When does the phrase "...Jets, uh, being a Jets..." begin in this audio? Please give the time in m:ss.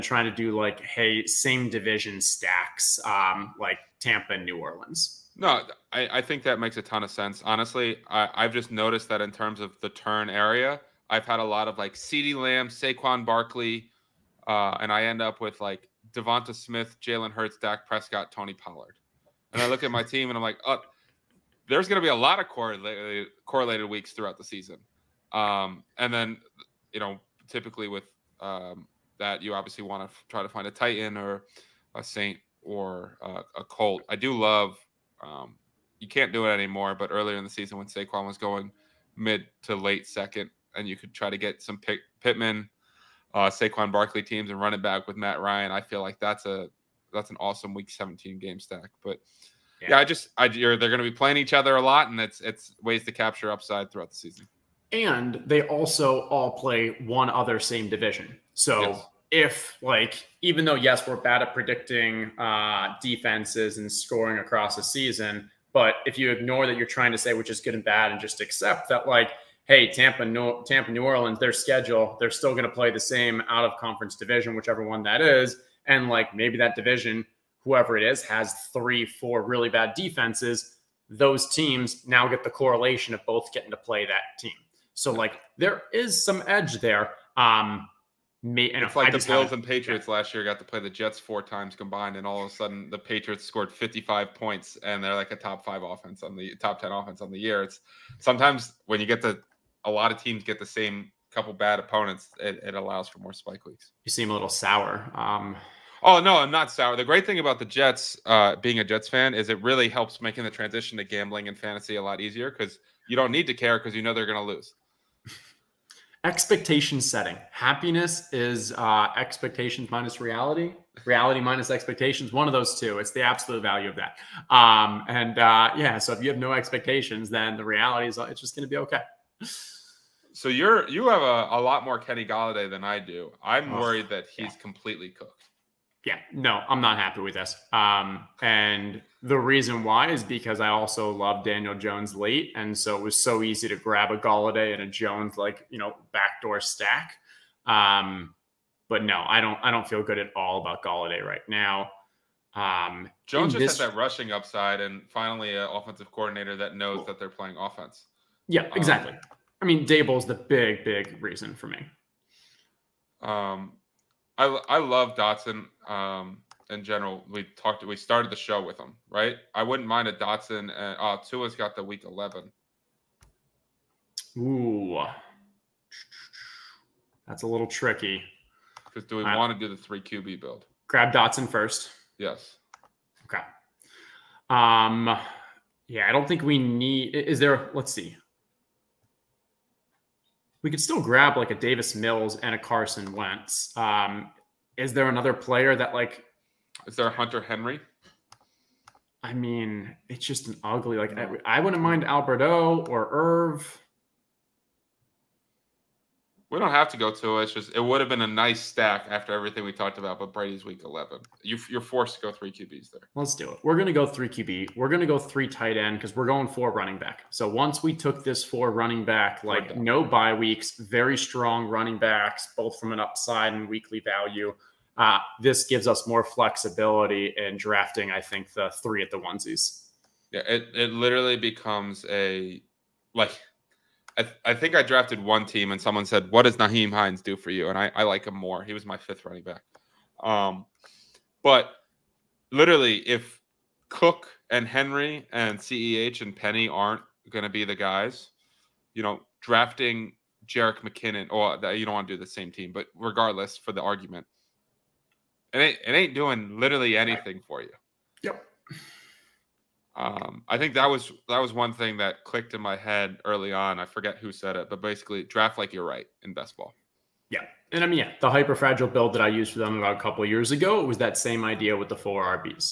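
1:47.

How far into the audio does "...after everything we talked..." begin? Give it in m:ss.
3:29.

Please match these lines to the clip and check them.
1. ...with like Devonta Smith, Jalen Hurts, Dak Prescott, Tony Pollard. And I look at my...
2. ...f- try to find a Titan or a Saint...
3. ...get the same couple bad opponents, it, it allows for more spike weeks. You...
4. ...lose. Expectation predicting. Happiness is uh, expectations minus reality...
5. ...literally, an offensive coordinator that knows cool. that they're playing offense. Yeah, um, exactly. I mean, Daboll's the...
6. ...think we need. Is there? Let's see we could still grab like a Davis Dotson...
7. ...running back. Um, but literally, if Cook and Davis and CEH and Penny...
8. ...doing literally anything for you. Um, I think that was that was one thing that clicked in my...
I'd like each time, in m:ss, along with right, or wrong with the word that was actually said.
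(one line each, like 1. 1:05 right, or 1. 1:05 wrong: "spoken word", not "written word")
1. 0:15 right
2. 0:30 right
3. 1:40 right
4. 1:54 wrong: "setting", not "predicting"
5. 2:35 wrong: "finally", not "literally"
6. 3:06 wrong: "Mills", not "Dotson"
7. 3:59 wrong: "Henry", not "Davis"
8. 4:16 right.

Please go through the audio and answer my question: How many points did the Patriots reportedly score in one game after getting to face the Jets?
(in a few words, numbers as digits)
55.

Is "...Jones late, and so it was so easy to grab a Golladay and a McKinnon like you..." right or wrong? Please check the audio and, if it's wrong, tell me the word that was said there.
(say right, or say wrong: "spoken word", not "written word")
wrong: "Jones", not "McKinnon".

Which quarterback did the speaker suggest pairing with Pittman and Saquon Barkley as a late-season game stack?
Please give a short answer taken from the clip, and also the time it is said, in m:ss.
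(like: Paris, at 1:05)
Matt Ryan, at 0:45.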